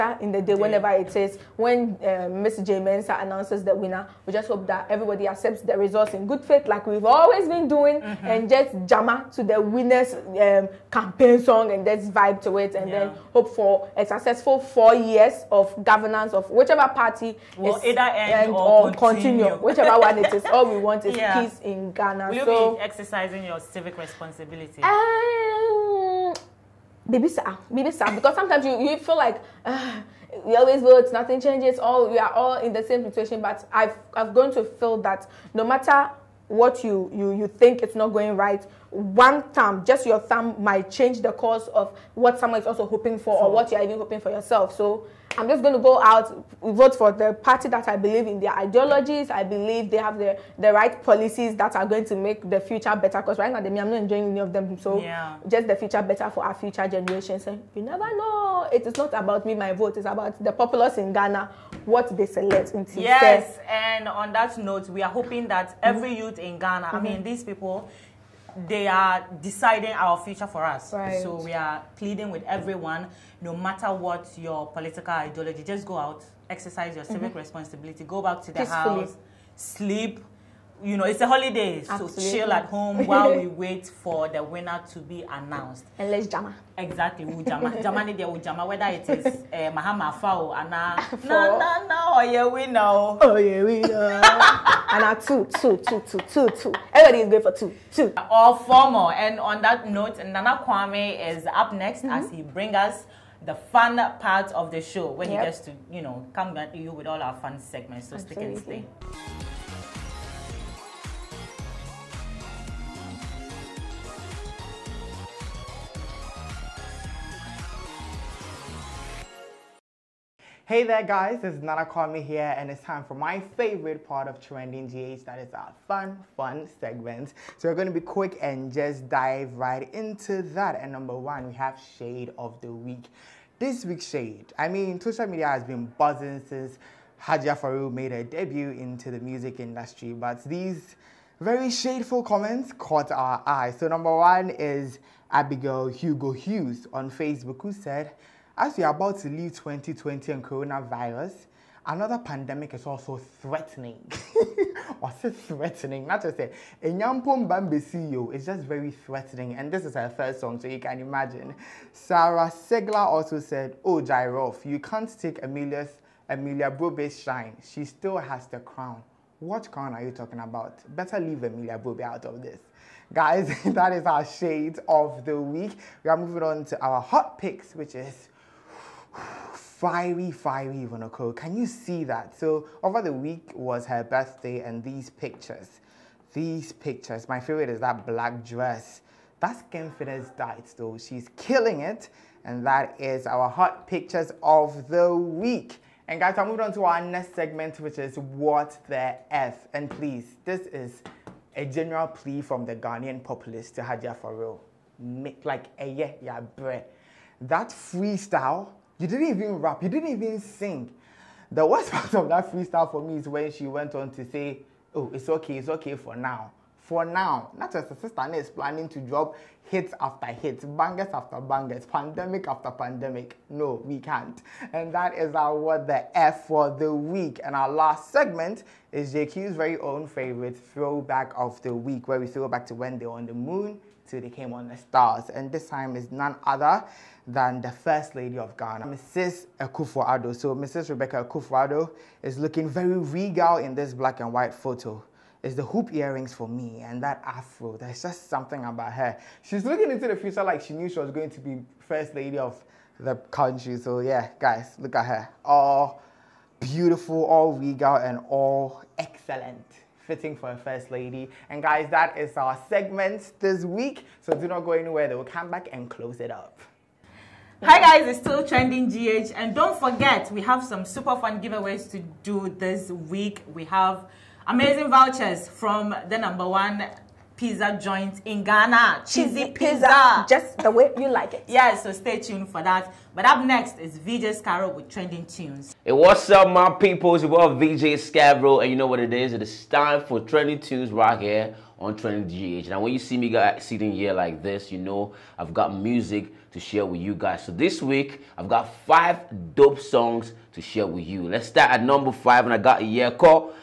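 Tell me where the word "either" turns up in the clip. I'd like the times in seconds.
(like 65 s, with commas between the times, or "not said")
17 s.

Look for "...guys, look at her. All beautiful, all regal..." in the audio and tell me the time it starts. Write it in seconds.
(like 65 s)
254 s.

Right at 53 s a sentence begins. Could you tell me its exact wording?
Because right now, they, I'm not enjoying any of them.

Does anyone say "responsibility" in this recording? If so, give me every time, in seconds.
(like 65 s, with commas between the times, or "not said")
23 s, 77 s.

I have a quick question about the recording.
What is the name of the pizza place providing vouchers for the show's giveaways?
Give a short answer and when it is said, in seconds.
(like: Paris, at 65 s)
Cheesy Cheesy pizza, at 279 s.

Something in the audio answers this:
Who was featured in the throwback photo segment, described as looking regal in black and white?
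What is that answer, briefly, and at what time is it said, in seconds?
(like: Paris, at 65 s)
Rebecca Akufo-Addo, at 240 s.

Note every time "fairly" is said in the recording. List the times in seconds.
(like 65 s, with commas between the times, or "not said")
not said.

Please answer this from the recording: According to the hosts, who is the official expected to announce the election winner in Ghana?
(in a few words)
Ms. J. Mensah.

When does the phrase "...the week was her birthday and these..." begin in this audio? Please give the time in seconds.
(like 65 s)
183 s.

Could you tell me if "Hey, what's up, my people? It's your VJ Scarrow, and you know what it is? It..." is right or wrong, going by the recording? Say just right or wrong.
right.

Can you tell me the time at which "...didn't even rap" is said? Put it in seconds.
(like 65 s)
209 s.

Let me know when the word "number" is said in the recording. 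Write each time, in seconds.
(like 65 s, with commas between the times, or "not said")
130 s, 143 s, 276 s, 301 s.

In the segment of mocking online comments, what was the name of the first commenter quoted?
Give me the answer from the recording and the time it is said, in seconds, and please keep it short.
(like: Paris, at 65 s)
Abigail Hugo Hughes, at 145 s.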